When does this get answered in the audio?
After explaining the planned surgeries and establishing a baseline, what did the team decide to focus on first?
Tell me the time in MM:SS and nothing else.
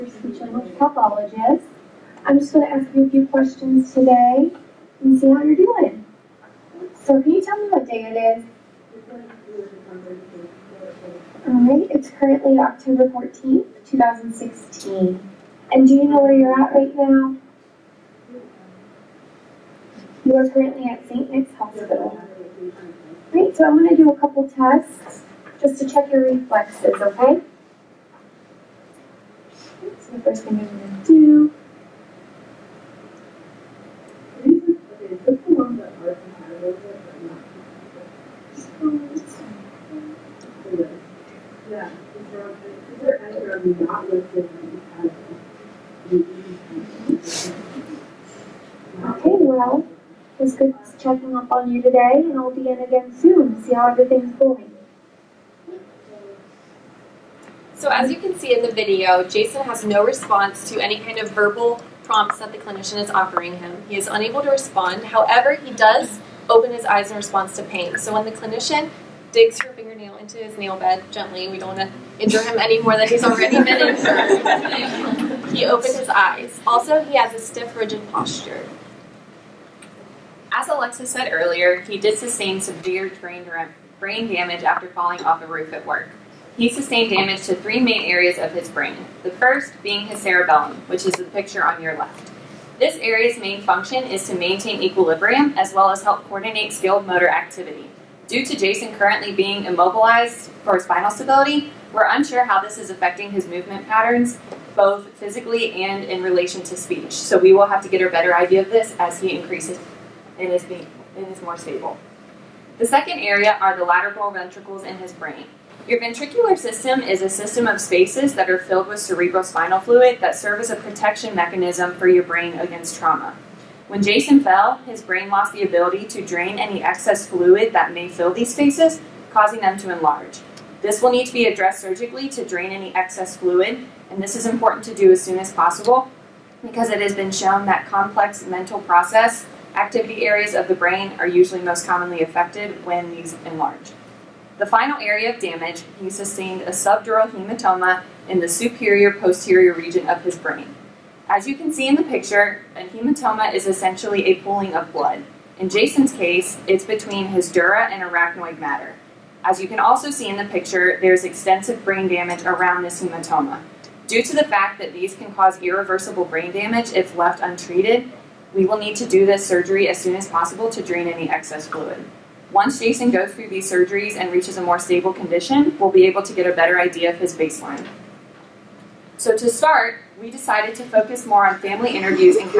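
03:01.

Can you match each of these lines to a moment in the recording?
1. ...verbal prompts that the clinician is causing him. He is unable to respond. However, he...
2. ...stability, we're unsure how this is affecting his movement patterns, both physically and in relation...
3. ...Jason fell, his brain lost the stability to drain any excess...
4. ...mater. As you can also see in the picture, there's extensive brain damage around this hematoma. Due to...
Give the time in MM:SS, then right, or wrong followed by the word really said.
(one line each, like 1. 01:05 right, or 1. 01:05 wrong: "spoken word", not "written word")
1. 01:01 wrong: "offering", not "causing"
2. 01:41 right
3. 02:04 wrong: "ability", not "stability"
4. 02:38 right.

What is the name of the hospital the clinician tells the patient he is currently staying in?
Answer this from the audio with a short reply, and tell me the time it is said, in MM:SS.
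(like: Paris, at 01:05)
St. Nick's Hospital, at 00:21.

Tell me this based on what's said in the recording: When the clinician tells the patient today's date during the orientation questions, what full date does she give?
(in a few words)
October 14, 2016.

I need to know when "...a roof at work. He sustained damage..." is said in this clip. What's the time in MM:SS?
01:25.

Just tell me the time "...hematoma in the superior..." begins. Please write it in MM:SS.
02:27.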